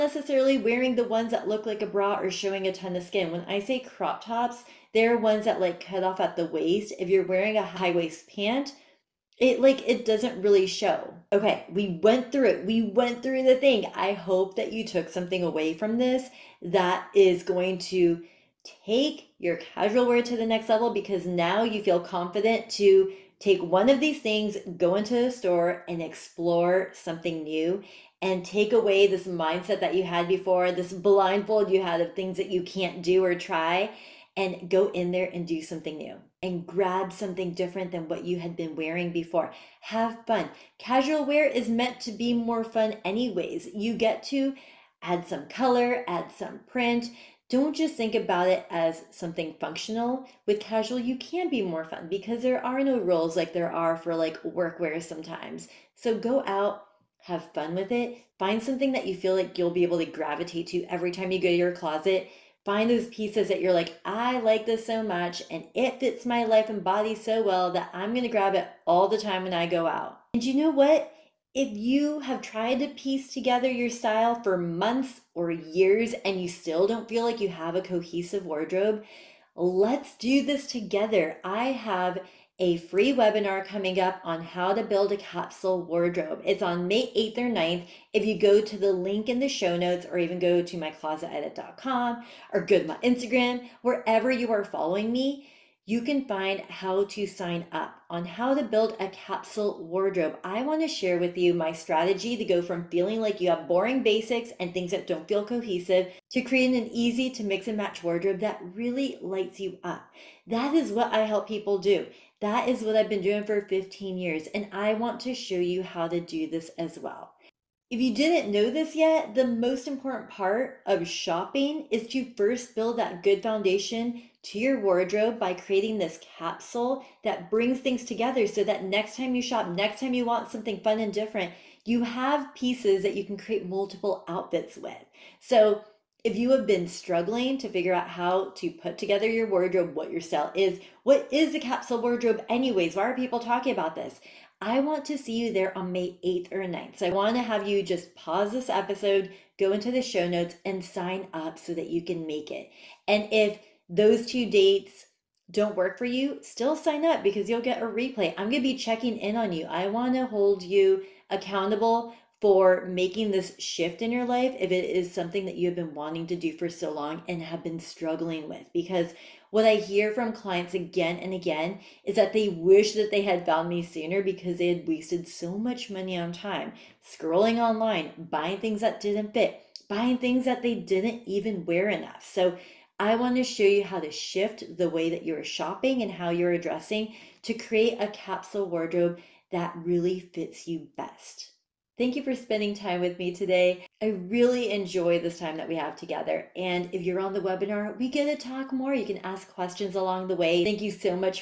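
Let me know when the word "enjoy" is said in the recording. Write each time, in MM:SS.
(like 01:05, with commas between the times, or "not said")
03:14.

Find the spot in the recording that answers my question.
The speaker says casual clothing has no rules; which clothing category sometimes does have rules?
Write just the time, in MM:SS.
00:54.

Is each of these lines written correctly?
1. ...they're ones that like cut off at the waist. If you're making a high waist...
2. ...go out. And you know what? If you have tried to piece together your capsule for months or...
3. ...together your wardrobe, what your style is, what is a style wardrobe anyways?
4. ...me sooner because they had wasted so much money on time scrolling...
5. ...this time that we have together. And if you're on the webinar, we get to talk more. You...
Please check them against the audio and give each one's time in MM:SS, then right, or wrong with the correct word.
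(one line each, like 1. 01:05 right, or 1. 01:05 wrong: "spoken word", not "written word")
1. 00:04 wrong: "wearing", not "making"
2. 01:09 wrong: "style", not "capsule"
3. 02:18 wrong: "capsule", not "style"
4. 02:53 right
5. 03:15 right.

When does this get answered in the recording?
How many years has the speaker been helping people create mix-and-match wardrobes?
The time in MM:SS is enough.
01:53.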